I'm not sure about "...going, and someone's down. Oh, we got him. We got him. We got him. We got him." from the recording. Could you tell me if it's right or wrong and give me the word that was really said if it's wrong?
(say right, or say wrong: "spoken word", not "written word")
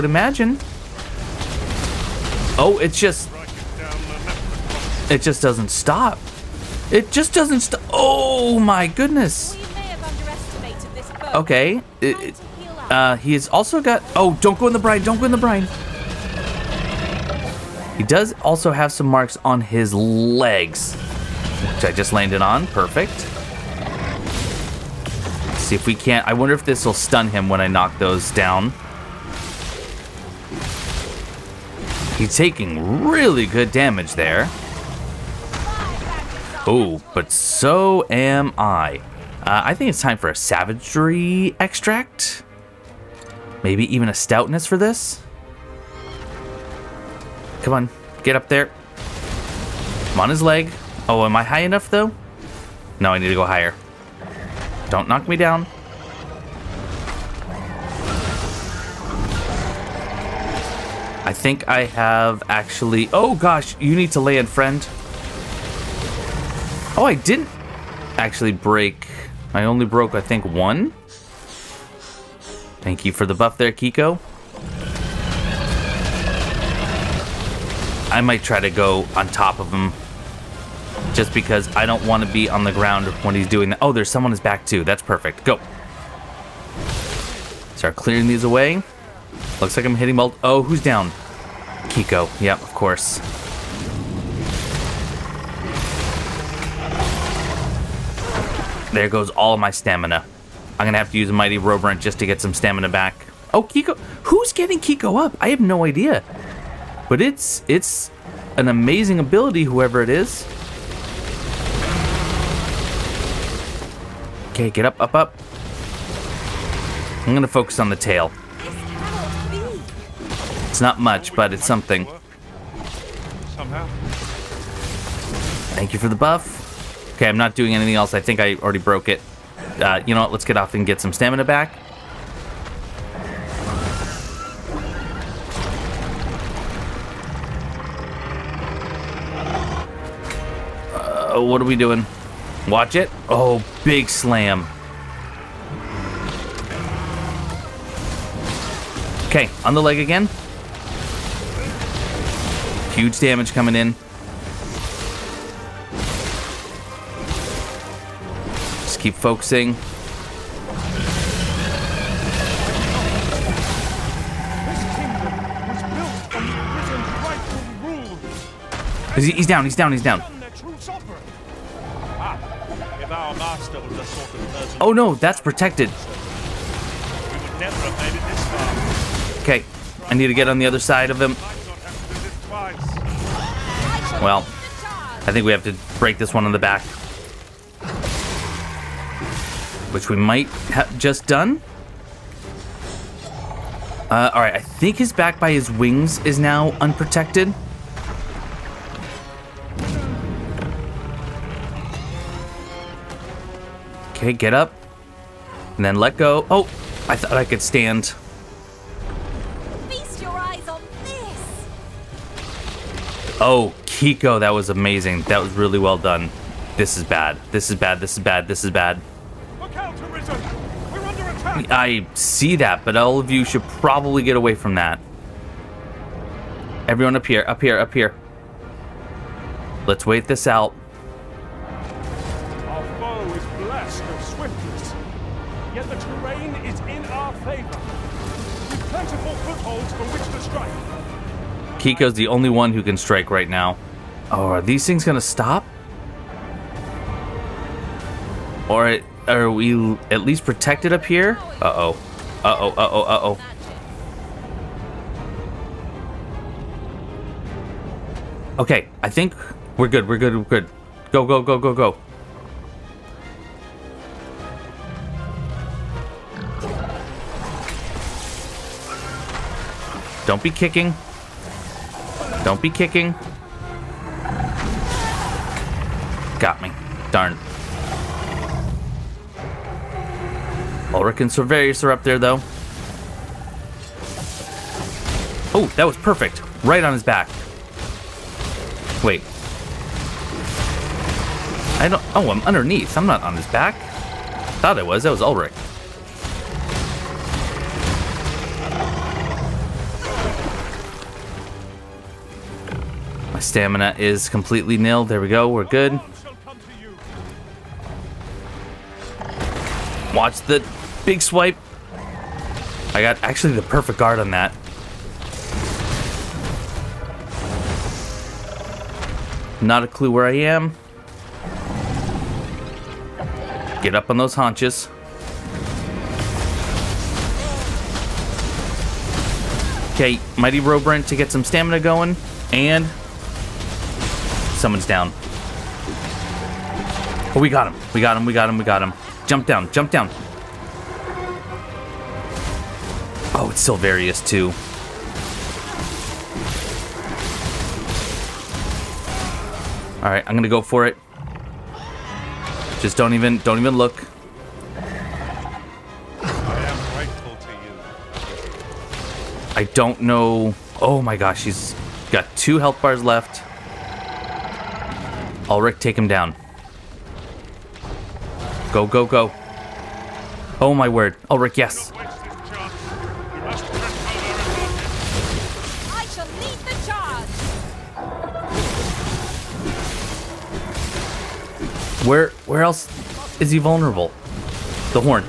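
right.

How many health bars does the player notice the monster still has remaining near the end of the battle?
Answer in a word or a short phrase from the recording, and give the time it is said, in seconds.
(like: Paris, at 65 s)
2, at 362 s.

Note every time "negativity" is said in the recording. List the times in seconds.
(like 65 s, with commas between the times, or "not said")
not said.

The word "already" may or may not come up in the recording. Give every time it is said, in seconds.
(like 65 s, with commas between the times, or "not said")
128 s.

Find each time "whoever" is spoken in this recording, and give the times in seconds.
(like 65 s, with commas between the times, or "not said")
109 s.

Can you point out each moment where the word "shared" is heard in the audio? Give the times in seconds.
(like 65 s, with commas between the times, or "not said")
not said.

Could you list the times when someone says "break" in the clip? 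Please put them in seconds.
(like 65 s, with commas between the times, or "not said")
68 s, 185 s.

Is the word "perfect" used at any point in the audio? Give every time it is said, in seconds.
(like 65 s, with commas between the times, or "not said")
22 s, 85 s, 285 s, 313 s.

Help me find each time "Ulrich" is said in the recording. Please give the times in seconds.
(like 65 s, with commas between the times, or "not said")
280 s, 295 s, 365 s, 371 s.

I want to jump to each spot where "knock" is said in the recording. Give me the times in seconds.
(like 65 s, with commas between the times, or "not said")
27 s, 55 s.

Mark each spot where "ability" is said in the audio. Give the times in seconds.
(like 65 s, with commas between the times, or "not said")
109 s.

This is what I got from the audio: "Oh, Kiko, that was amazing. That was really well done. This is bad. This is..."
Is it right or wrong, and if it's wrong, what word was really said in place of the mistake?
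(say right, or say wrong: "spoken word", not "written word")
right.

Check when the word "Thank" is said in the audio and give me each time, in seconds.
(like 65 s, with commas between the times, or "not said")
72 s, 125 s.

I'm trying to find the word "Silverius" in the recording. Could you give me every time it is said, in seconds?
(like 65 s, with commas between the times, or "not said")
281 s, 343 s.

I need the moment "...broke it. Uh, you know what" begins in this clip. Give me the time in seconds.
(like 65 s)
128 s.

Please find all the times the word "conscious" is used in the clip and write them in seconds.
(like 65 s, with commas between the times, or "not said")
not said.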